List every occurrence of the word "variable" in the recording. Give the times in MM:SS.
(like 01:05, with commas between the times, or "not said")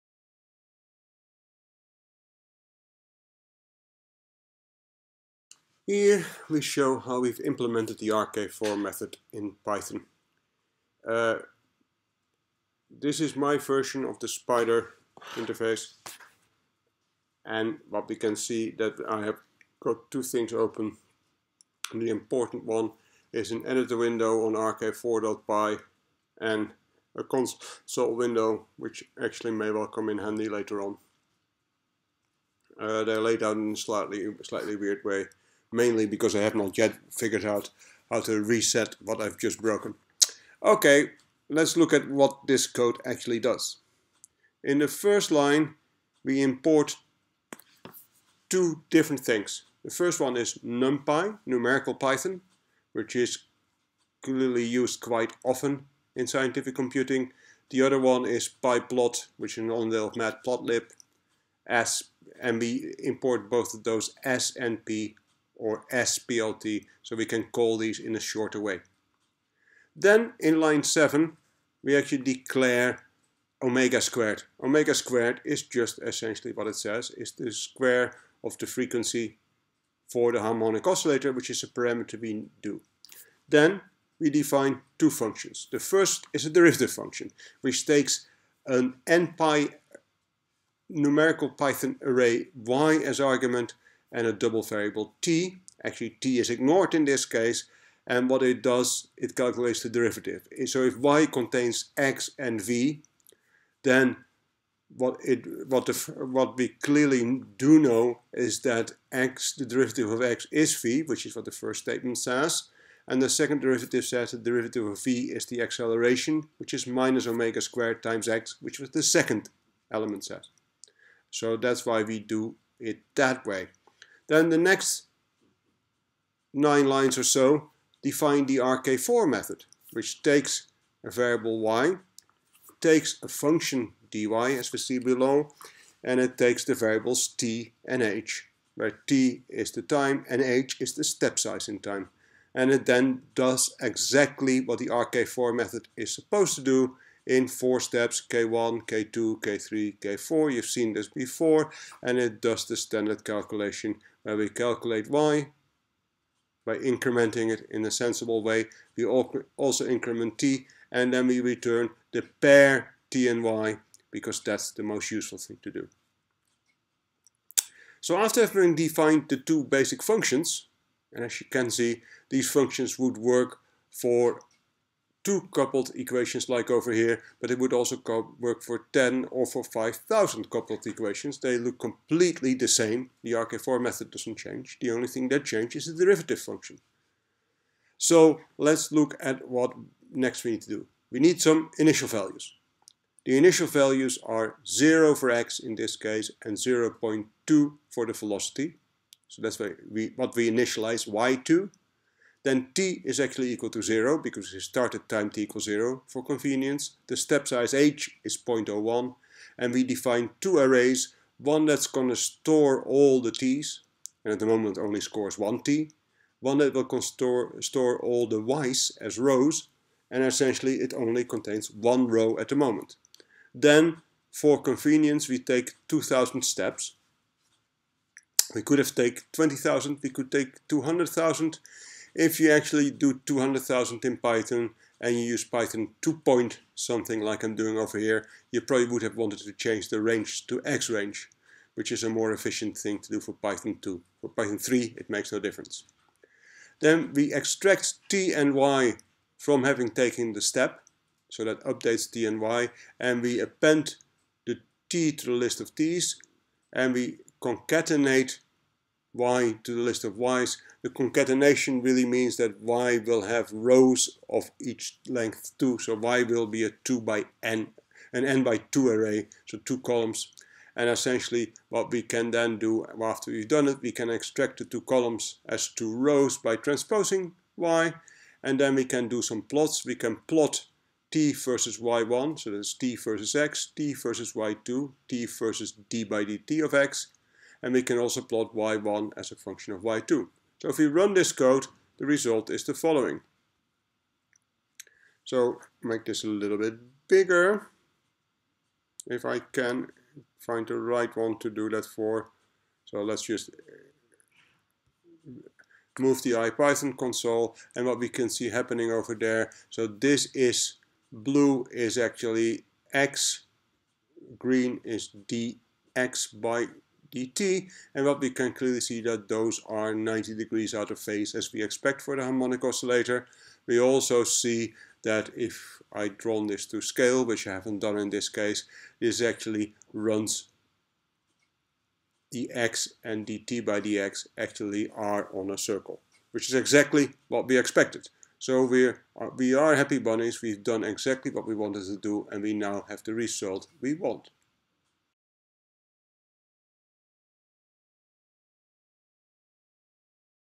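01:34, 02:11, 02:16.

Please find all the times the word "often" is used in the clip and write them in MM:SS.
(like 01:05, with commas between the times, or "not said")
00:55.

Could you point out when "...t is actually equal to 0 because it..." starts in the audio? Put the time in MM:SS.
03:22.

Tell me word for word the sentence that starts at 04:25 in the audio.
So y will be a 2 by n, an n by 2 array, so two columns.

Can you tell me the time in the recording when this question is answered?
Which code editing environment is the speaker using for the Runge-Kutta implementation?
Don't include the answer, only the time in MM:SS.
00:14.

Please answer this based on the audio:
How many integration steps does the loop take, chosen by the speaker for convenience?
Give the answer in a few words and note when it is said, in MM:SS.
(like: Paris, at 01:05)
2,000, at 03:45.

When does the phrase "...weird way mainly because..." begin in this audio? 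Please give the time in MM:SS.
00:34.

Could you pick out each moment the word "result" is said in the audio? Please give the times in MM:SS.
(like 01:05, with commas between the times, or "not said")
04:52, 05:43.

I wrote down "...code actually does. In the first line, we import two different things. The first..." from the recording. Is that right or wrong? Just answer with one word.
right.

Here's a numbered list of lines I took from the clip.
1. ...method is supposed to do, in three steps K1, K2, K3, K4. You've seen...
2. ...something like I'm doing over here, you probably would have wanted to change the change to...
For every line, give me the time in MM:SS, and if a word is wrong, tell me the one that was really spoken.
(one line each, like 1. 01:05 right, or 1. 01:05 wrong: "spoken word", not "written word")
1. 02:25 wrong: "four", not "three"
2. 03:56 wrong: "range", not "change".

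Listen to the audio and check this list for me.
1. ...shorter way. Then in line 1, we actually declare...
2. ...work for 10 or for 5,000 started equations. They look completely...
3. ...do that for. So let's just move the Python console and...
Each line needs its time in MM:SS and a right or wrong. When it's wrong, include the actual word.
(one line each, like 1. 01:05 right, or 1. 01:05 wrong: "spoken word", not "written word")
1. 01:08 wrong: "7", not "1"
2. 02:58 wrong: "coupled", not "started"
3. 05:01 wrong: "IPython", not "Python".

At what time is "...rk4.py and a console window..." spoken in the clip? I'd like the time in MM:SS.
00:24.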